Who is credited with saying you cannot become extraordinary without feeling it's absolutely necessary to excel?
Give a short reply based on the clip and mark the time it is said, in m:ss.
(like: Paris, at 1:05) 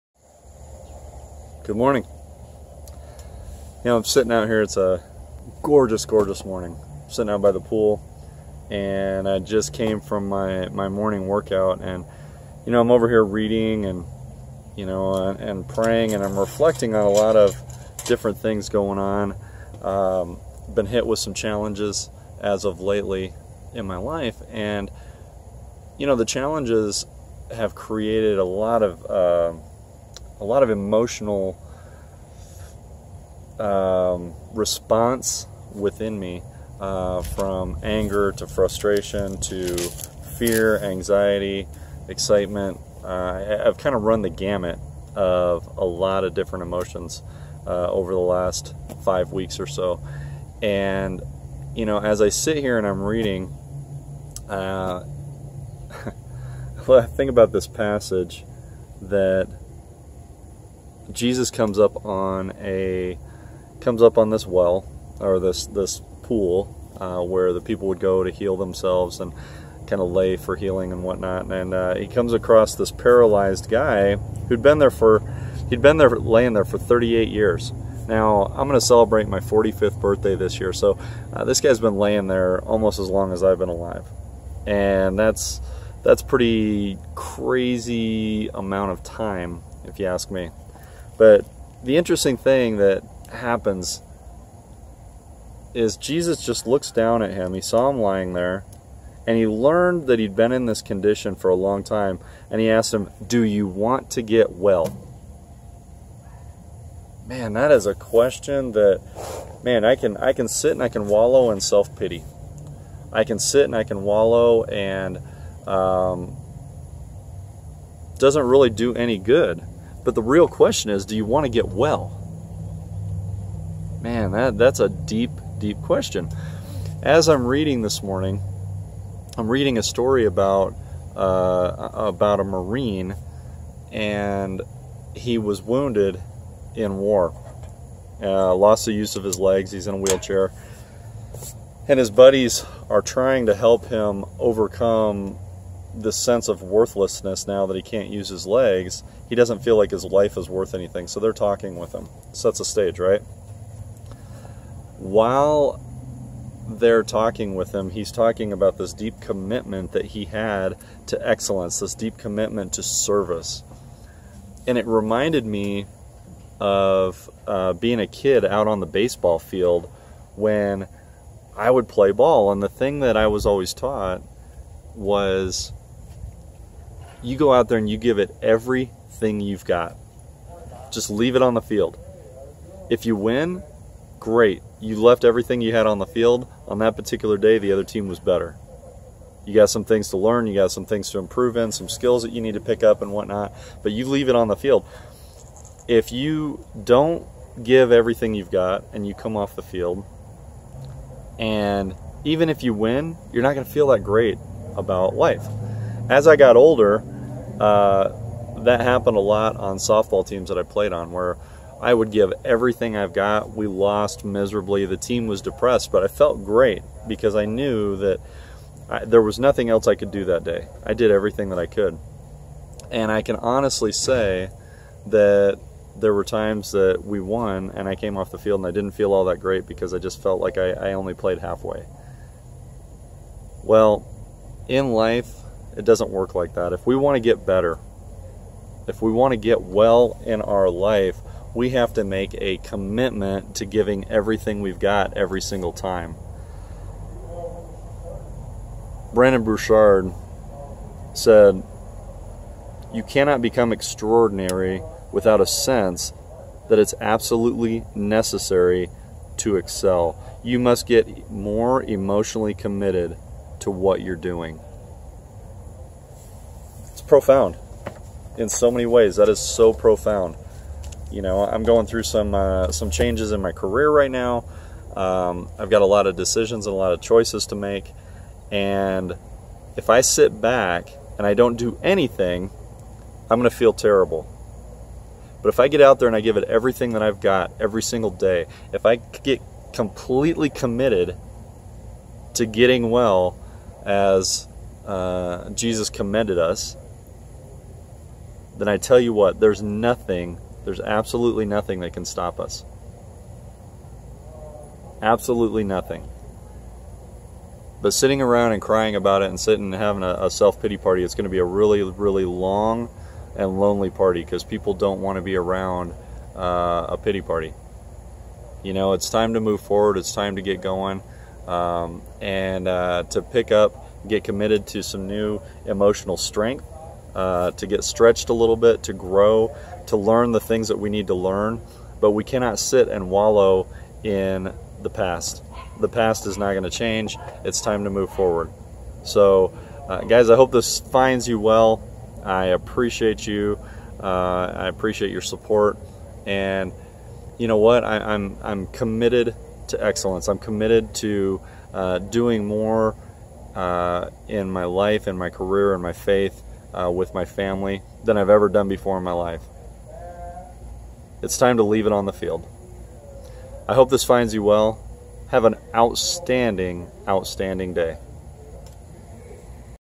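Brendon Burchard, at 4:09.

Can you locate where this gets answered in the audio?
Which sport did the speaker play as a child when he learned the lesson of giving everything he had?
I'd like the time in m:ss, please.
2:48.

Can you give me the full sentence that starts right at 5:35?
The past is not going to change.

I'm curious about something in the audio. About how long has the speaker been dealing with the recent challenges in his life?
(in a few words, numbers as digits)
five weeks.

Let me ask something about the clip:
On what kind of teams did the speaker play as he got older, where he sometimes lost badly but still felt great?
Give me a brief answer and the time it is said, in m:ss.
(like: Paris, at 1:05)
softball, at 3:29.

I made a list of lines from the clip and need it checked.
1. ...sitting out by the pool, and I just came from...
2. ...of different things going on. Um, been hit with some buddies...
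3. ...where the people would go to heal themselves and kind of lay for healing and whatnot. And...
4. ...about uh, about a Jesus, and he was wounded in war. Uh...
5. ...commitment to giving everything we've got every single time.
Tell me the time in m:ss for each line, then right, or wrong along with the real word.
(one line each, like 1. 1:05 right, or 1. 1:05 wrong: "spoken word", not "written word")
1. 0:07 right
2. 0:17 wrong: "challenges", not "buddies"
3. 1:07 right
4. 2:10 wrong: "Marine", not "Jesus"
5. 4:02 right.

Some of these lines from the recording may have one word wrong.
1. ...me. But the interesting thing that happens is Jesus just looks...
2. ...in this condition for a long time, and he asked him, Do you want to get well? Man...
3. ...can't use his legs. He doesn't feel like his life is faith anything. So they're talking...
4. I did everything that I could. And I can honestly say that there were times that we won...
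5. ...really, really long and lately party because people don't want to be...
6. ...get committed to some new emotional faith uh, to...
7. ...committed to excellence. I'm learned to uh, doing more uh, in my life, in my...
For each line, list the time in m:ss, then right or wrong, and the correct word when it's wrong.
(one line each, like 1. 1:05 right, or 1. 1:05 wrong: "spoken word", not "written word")
1. 1:30 right
2. 1:40 right
3. 2:27 wrong: "worth", not "faith"
4. 3:40 right
5. 5:11 wrong: "lonely", not "lately"
6. 5:24 wrong: "strength", not "faith"
7. 5:48 wrong: "committed", not "learned".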